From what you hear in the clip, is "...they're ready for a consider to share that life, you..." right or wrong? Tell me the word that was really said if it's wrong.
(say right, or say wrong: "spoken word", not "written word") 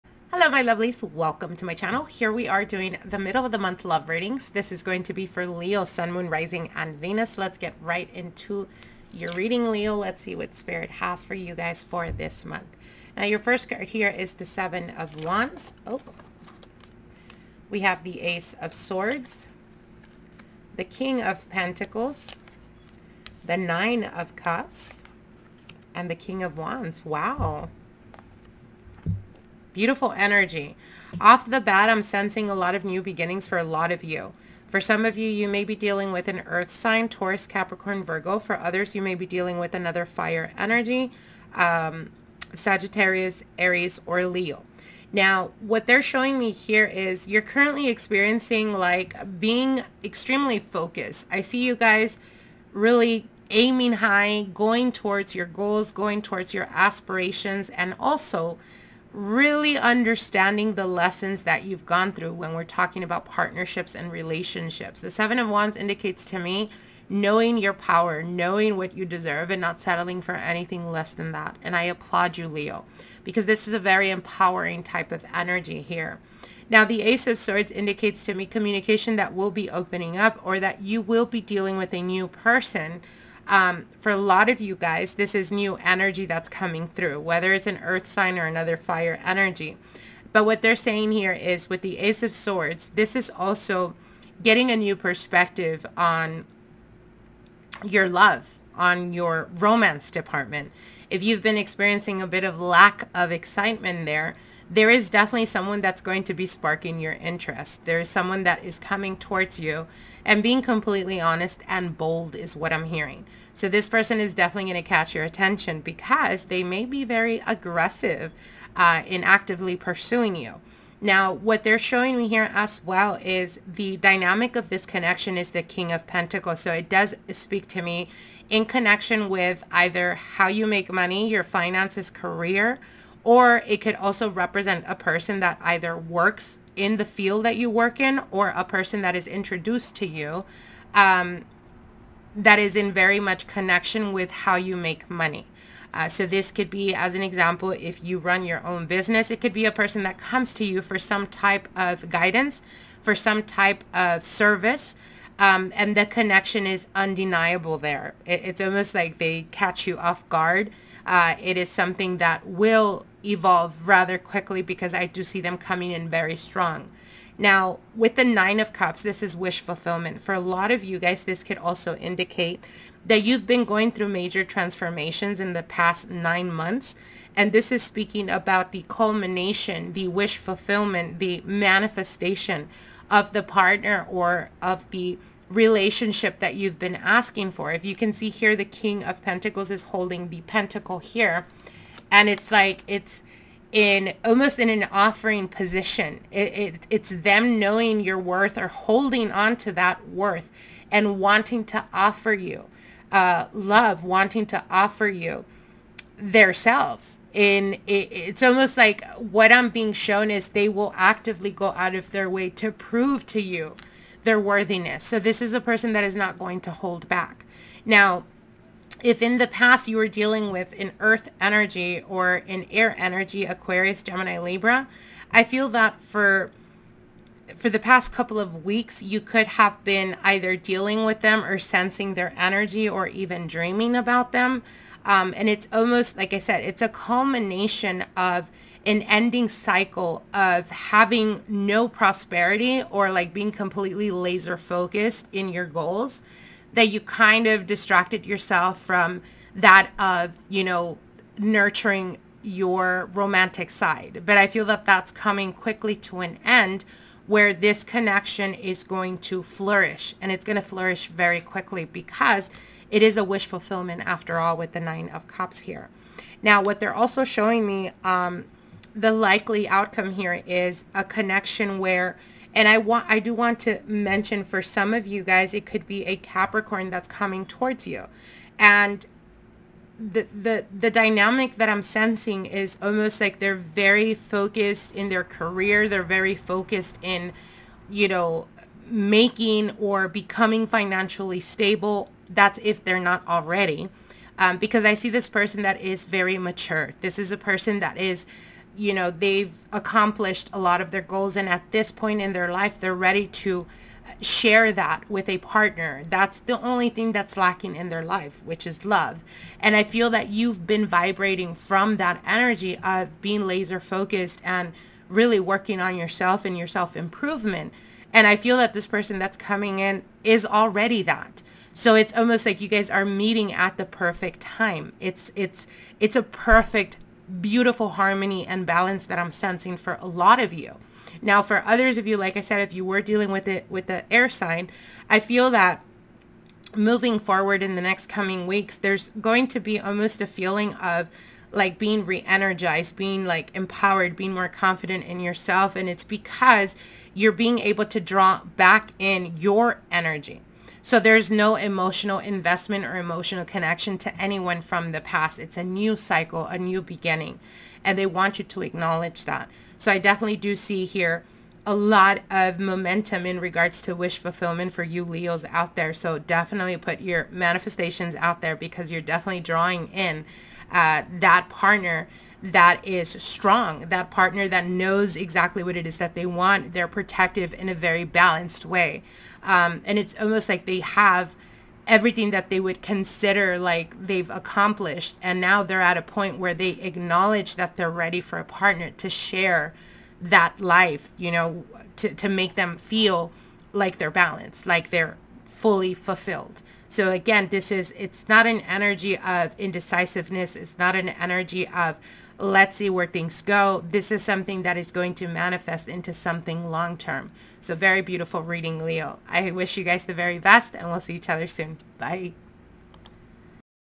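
wrong: "partner", not "consider".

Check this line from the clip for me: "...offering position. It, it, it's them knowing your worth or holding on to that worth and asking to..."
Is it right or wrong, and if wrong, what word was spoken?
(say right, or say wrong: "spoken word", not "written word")
wrong: "wanting", not "asking".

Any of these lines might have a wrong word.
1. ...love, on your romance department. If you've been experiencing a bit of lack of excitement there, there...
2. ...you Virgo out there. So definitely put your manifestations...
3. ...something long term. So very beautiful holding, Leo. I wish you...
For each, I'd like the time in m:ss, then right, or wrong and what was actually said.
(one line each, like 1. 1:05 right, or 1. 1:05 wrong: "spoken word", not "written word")
1. 1:38 right
2. 6:04 wrong: "Leos", not "Virgo"
3. 6:46 wrong: "reading", not "holding".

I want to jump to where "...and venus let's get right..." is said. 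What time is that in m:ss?
0:06.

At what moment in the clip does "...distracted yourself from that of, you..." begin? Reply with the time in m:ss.
4:07.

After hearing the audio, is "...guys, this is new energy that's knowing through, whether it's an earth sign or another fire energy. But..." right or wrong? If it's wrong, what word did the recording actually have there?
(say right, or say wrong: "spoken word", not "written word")
wrong: "coming", not "knowing".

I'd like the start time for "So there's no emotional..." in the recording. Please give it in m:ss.
5:50.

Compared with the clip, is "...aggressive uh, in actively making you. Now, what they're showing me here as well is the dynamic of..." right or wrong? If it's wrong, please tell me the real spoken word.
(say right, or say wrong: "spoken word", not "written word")
wrong: "pursuing", not "making".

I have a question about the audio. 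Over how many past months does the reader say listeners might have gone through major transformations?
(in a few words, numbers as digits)
9.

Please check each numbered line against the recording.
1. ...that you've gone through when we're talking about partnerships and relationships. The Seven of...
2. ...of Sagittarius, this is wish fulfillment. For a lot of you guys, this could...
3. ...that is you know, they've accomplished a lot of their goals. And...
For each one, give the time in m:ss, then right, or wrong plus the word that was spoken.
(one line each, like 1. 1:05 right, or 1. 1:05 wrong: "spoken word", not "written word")
1. 1:01 right
2. 2:48 wrong: "Cups", not "Sagittarius"
3. 4:57 right.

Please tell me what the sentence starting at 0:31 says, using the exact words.
Off the bat, I'm sensing a lot of new beginnings for a lot of you.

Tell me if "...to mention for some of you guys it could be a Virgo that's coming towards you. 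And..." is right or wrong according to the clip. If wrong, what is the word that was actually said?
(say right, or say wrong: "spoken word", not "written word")
wrong: "Capricorn", not "Virgo".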